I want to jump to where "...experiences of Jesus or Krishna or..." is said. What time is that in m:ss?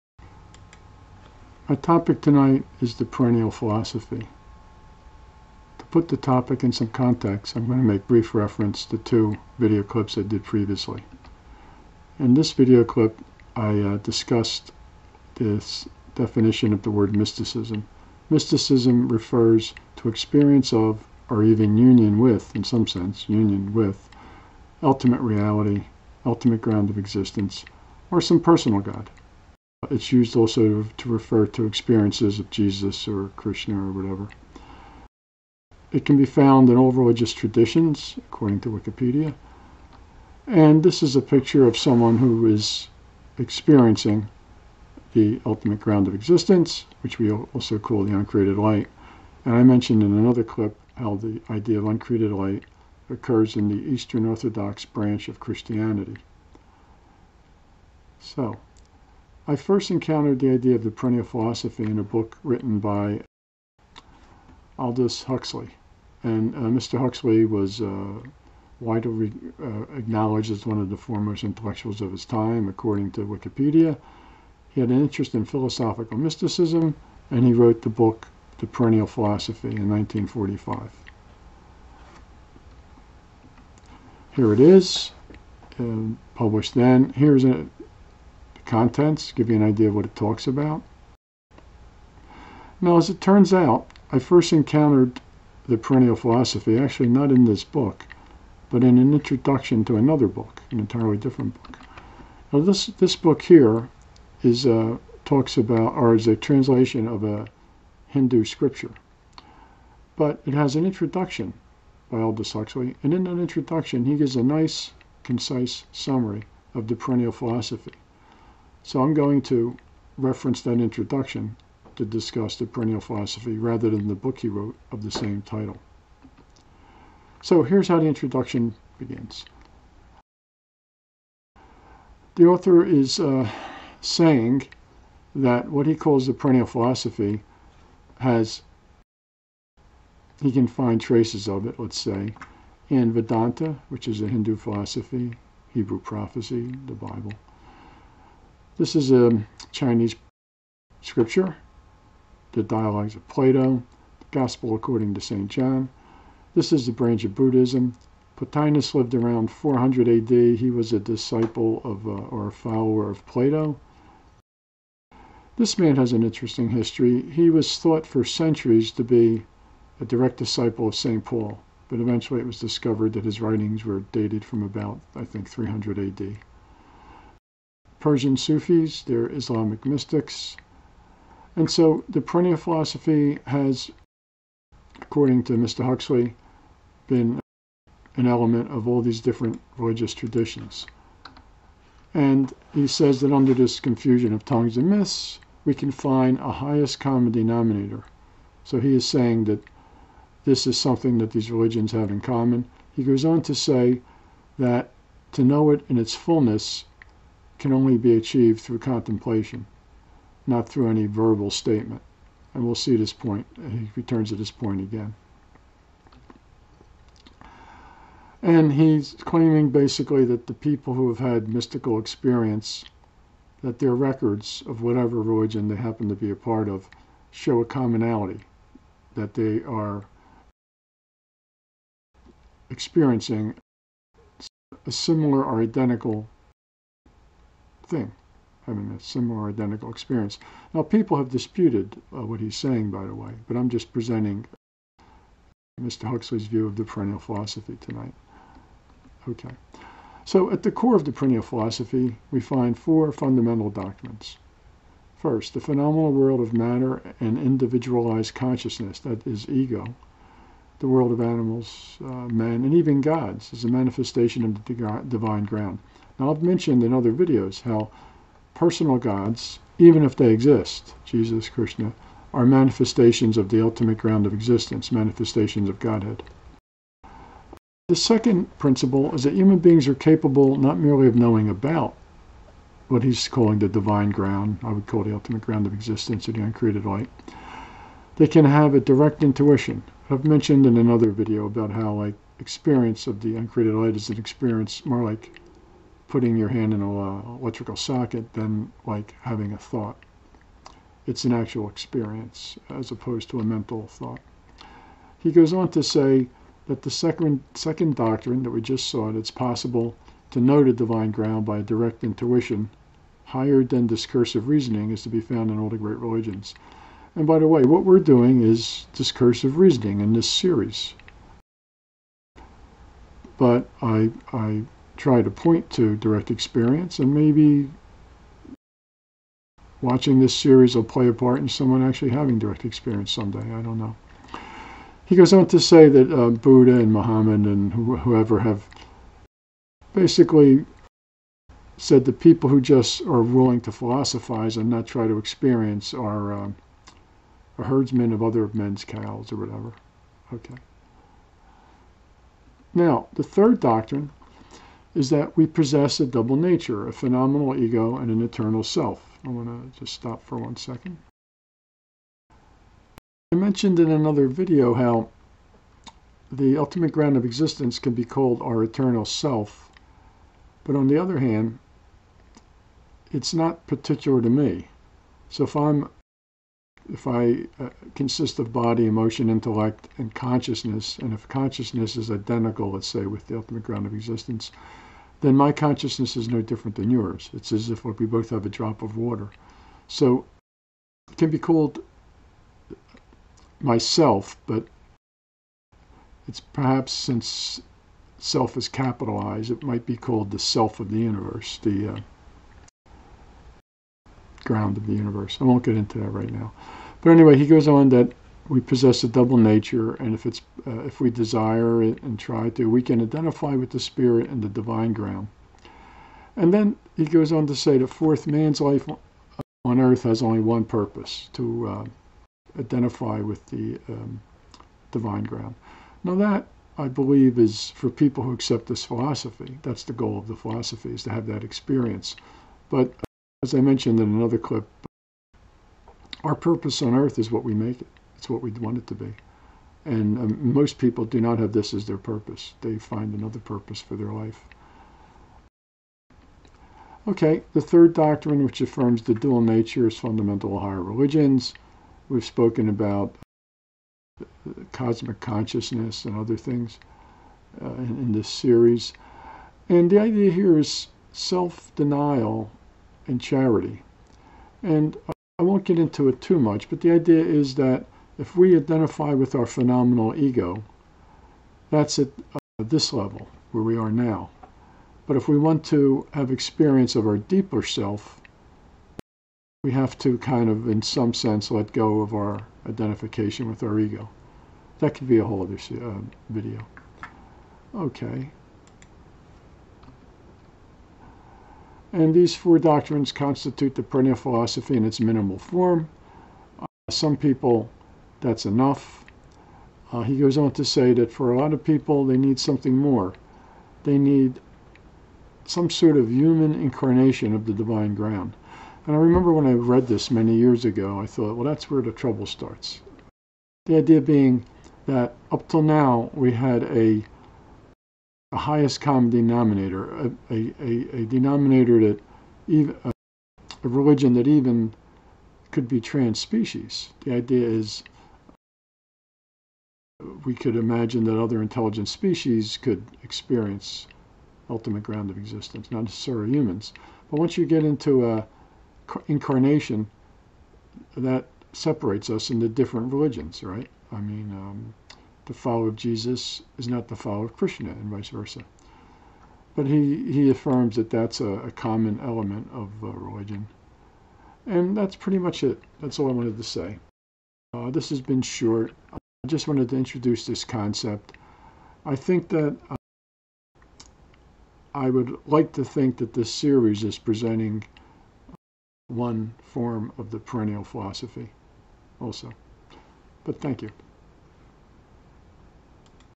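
0:31.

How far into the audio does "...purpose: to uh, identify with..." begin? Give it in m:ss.
7:00.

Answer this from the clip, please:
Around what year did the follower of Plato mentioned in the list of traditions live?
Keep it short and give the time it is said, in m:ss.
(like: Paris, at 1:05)
400 AD, at 2:39.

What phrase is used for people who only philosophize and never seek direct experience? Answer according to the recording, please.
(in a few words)
herdsman of other men's cows.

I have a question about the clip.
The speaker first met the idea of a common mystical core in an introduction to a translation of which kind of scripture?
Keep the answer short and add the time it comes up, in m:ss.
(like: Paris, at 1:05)
Hindu scripture, at 1:48.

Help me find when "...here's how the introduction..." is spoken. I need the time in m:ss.
2:07.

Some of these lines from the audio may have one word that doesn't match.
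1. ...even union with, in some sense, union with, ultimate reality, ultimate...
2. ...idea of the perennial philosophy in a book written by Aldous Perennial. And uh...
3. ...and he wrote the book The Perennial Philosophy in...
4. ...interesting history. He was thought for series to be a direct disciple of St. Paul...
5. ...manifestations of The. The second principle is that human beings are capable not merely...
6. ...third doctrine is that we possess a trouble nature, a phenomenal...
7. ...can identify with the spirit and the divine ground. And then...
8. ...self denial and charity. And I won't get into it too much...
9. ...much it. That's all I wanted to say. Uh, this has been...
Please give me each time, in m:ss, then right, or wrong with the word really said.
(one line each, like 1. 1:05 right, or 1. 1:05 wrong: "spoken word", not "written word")
1. 0:21 right
2. 1:00 wrong: "Huxley", not "Perennial"
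3. 1:17 right
4. 2:46 wrong: "centuries", not "series"
5. 4:34 wrong: "Godhead", not "The"
6. 5:53 wrong: "double", not "trouble"
7. 6:52 right
8. 7:41 right
9. 9:15 right.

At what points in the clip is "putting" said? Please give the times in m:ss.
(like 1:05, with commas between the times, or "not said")
4:56.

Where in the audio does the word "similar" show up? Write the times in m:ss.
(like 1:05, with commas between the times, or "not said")
3:54, 3:59.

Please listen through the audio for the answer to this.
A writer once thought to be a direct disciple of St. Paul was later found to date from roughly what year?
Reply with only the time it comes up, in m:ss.
2:55.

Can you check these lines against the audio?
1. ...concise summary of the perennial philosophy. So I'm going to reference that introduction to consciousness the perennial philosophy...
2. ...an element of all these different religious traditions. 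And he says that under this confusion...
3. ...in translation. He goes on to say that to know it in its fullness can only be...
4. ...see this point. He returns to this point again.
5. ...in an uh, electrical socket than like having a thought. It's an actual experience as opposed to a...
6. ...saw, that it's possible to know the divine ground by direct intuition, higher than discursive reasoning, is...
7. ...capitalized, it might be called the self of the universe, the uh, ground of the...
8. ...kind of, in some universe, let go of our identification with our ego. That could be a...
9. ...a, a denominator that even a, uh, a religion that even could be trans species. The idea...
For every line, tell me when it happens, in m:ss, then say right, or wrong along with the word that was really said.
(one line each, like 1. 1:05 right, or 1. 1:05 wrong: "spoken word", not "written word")
1. 1:55 wrong: "discuss", not "consciousness"
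2. 3:08 right
3. 3:22 wrong: "common", not "translation"
4. 3:32 right
5. 4:56 right
6. 5:08 right
7. 6:38 right
8. 8:00 wrong: "sense", not "universe"
9. 8:40 right.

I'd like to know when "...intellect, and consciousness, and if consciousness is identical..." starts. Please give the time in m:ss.
6:19.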